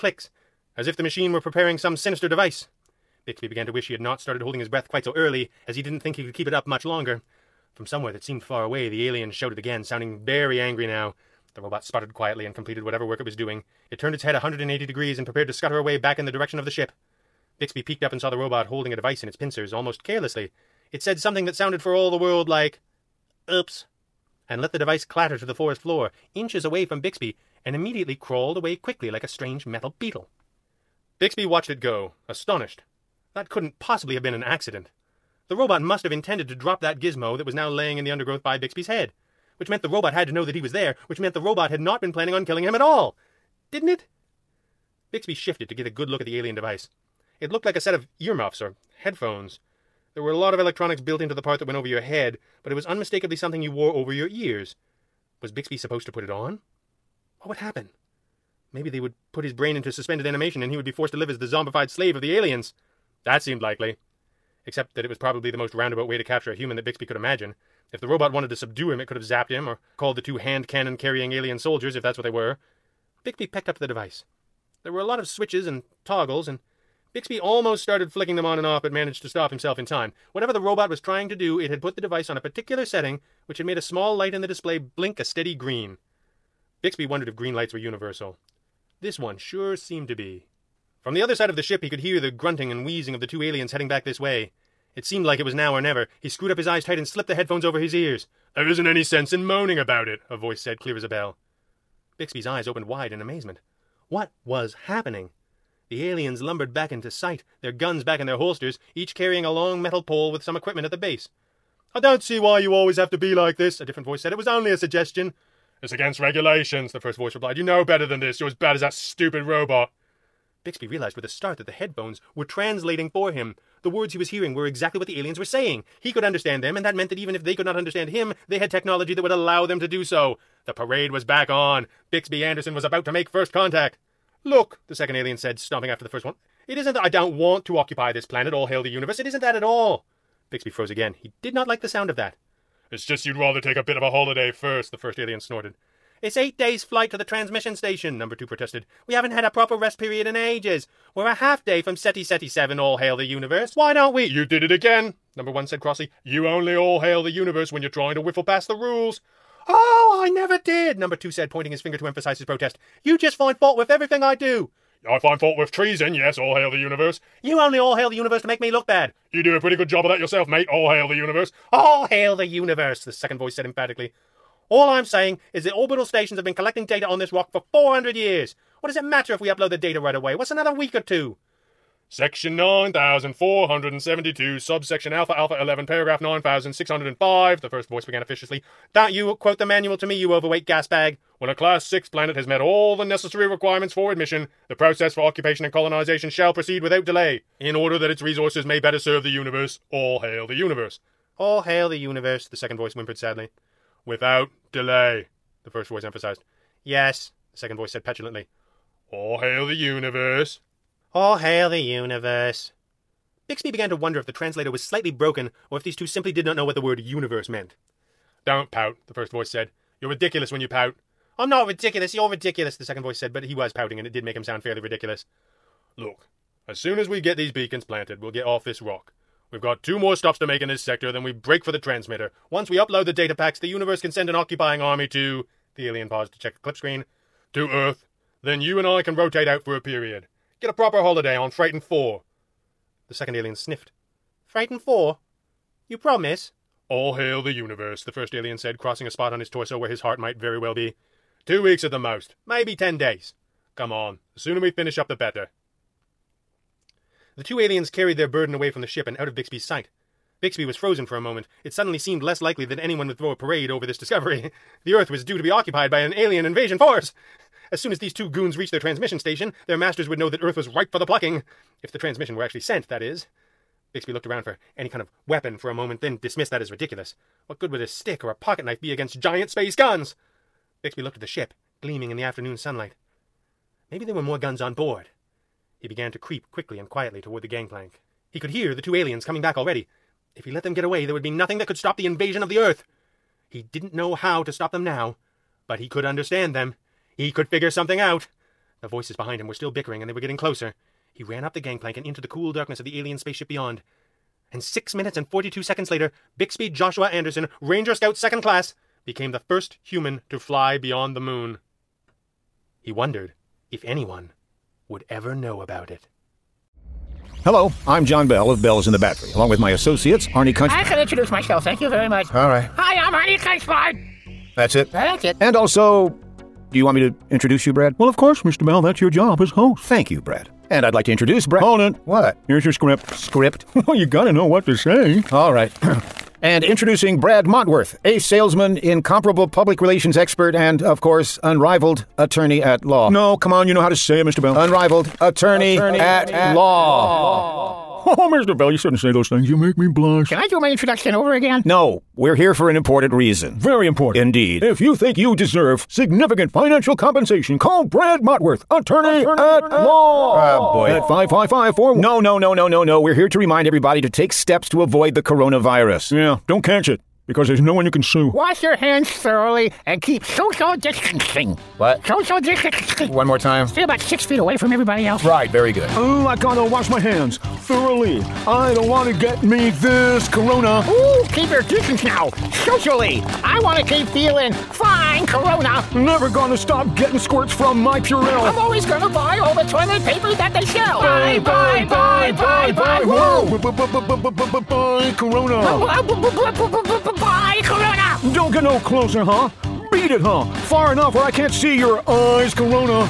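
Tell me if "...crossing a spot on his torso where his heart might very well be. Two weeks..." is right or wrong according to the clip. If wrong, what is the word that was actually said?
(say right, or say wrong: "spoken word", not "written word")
right.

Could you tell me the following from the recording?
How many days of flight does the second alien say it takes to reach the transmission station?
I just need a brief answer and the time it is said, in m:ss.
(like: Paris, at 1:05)
8, at 2:26.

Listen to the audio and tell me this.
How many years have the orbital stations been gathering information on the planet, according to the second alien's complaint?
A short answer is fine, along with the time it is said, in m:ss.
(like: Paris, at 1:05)
400, at 2:57.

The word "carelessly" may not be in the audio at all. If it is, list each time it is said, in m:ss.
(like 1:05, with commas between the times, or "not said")
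0:20.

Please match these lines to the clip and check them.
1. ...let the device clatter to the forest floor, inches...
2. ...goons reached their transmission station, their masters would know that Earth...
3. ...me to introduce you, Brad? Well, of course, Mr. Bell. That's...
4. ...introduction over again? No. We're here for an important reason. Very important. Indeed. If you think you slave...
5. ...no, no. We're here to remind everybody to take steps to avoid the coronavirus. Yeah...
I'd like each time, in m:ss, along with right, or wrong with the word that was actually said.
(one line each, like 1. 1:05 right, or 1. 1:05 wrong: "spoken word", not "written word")
1. 0:24 right
2. 4:28 right
3. 5:26 right
4. 5:50 wrong: "deserve", not "slave"
5. 6:02 right.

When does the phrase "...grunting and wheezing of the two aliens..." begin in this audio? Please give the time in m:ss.
1:32.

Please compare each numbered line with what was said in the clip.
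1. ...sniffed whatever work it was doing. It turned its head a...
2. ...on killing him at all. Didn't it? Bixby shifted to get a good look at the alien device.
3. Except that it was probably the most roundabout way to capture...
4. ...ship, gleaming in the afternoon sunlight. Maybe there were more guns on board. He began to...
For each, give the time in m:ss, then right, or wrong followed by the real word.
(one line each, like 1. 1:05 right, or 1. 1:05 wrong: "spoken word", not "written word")
1. 0:12 wrong: "completed", not "sniffed"
2. 0:42 right
3. 1:04 right
4. 4:41 right.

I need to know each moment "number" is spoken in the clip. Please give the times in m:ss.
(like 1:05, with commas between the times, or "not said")
2:28, 2:35, 2:40.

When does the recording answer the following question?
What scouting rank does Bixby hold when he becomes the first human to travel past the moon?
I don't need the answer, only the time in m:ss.
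5:07.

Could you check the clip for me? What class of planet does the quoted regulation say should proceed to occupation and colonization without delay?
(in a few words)
Class 6.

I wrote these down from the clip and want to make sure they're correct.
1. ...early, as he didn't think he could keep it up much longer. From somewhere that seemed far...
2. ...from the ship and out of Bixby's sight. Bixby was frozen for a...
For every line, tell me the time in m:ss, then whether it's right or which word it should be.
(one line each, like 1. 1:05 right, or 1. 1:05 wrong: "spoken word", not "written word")
1. 0:05 right
2. 4:18 right.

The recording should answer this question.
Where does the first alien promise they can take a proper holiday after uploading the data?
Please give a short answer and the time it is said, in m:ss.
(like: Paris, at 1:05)
Freighton 4, at 4:01.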